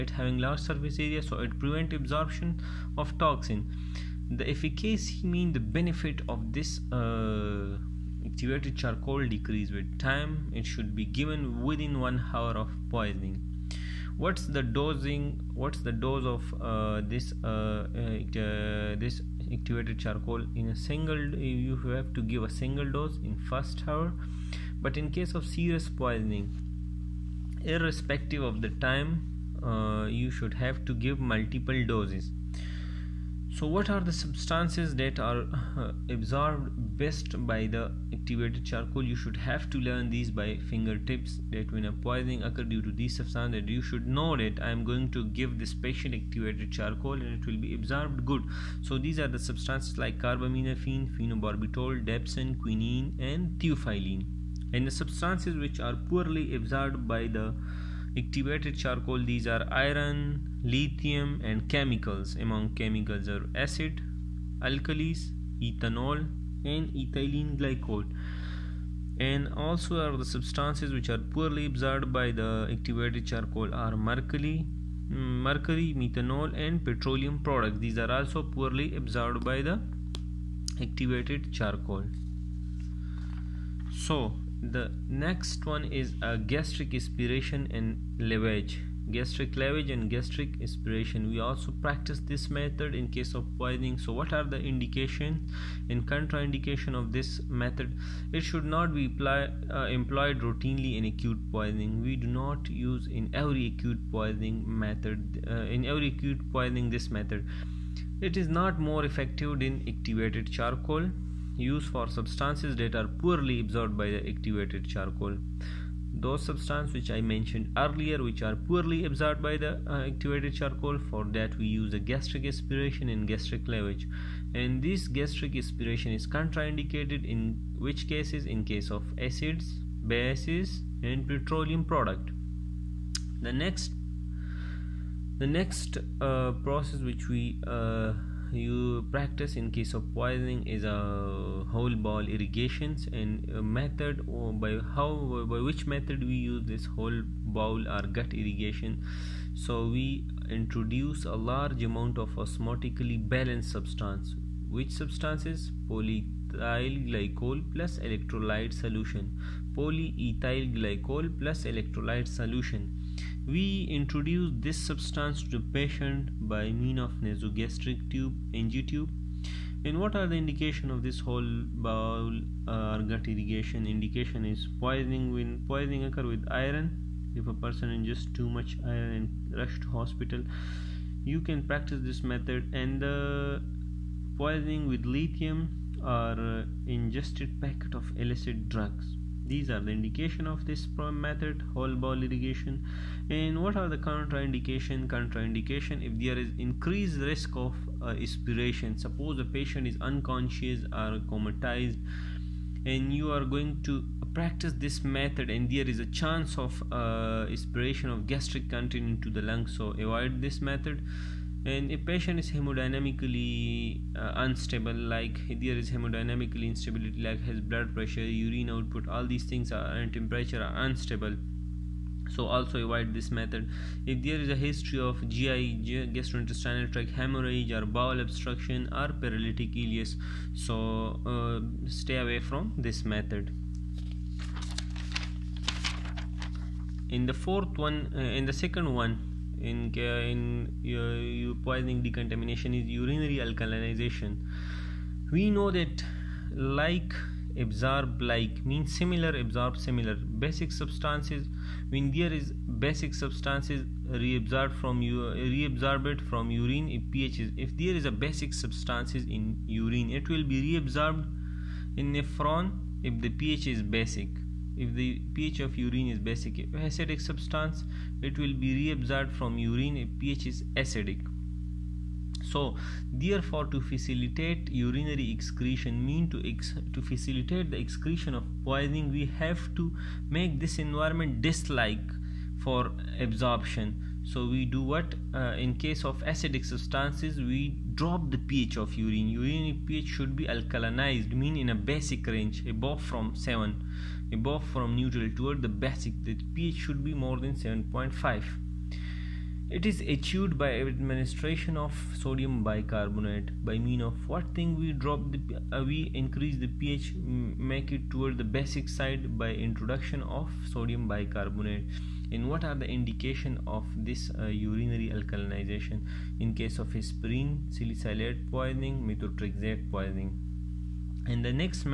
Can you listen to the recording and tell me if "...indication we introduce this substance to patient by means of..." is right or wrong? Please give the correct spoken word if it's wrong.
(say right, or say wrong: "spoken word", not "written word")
wrong: "solution", not "indication".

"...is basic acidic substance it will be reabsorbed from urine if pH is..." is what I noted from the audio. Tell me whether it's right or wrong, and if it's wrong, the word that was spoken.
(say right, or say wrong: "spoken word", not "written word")
right.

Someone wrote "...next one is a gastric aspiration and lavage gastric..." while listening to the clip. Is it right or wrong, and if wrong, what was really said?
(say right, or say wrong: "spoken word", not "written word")
right.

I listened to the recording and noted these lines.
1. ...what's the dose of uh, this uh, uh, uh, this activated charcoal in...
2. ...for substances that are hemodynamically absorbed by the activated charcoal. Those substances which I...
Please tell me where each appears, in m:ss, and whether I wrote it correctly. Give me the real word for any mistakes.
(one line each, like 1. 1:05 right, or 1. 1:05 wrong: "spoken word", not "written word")
1. 0:15 right
2. 1:51 wrong: "poorly", not "hemodynamically".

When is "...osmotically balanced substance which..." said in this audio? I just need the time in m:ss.
2:32.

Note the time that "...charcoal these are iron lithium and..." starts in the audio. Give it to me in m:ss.
0:58.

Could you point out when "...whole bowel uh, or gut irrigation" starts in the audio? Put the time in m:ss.
2:51.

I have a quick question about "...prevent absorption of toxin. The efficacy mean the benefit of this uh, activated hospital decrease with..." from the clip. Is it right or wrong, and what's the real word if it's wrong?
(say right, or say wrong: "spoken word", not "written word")
wrong: "charcoal", not "hospital".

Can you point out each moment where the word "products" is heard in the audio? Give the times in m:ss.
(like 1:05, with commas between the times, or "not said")
1:17, 2:11.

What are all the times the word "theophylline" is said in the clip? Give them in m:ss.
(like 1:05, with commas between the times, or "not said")
0:53.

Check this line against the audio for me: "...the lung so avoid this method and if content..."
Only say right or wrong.
wrong.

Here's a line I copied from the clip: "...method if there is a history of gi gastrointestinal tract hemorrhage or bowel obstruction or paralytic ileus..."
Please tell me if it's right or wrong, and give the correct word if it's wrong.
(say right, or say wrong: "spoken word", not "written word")
right.